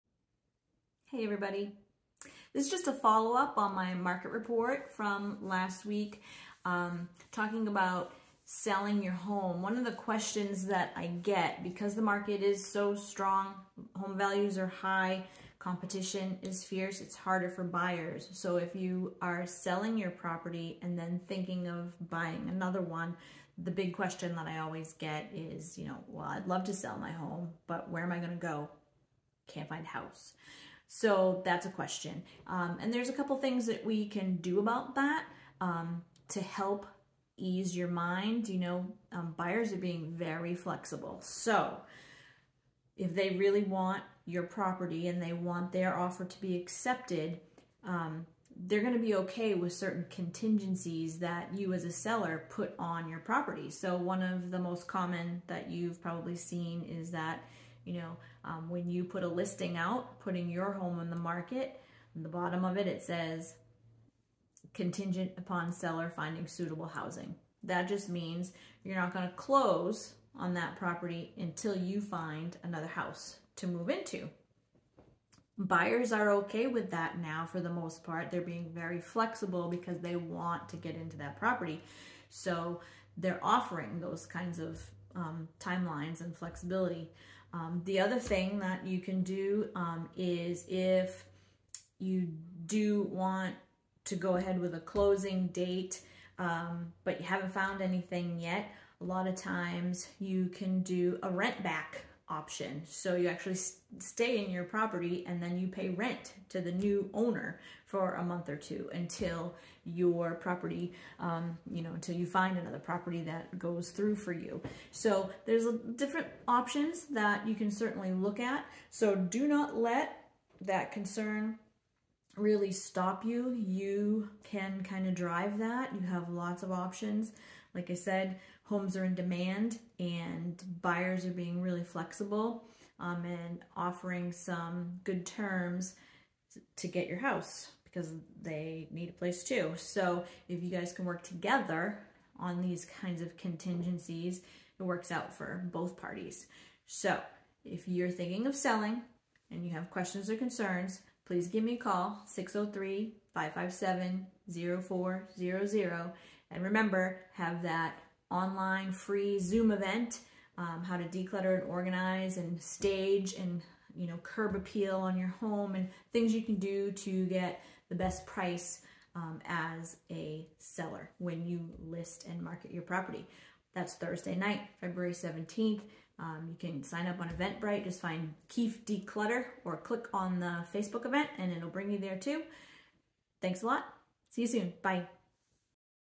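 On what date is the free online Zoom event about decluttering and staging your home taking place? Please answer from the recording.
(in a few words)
February 17th.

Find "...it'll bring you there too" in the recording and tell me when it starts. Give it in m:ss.
3:01.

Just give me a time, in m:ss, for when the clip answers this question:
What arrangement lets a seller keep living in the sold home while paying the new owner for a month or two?
1:41.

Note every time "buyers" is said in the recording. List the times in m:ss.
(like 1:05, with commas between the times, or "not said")
0:17, 0:39, 1:15, 2:10.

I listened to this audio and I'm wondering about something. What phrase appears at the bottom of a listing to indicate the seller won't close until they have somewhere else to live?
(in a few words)
Contingent upon seller finding suitable housing.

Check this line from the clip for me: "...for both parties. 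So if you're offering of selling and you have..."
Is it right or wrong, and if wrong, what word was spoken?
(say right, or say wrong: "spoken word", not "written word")
wrong: "thinking", not "offering".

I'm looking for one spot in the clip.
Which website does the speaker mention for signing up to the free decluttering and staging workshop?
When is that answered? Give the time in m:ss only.
2:57.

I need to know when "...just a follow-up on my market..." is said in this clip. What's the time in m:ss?
0:02.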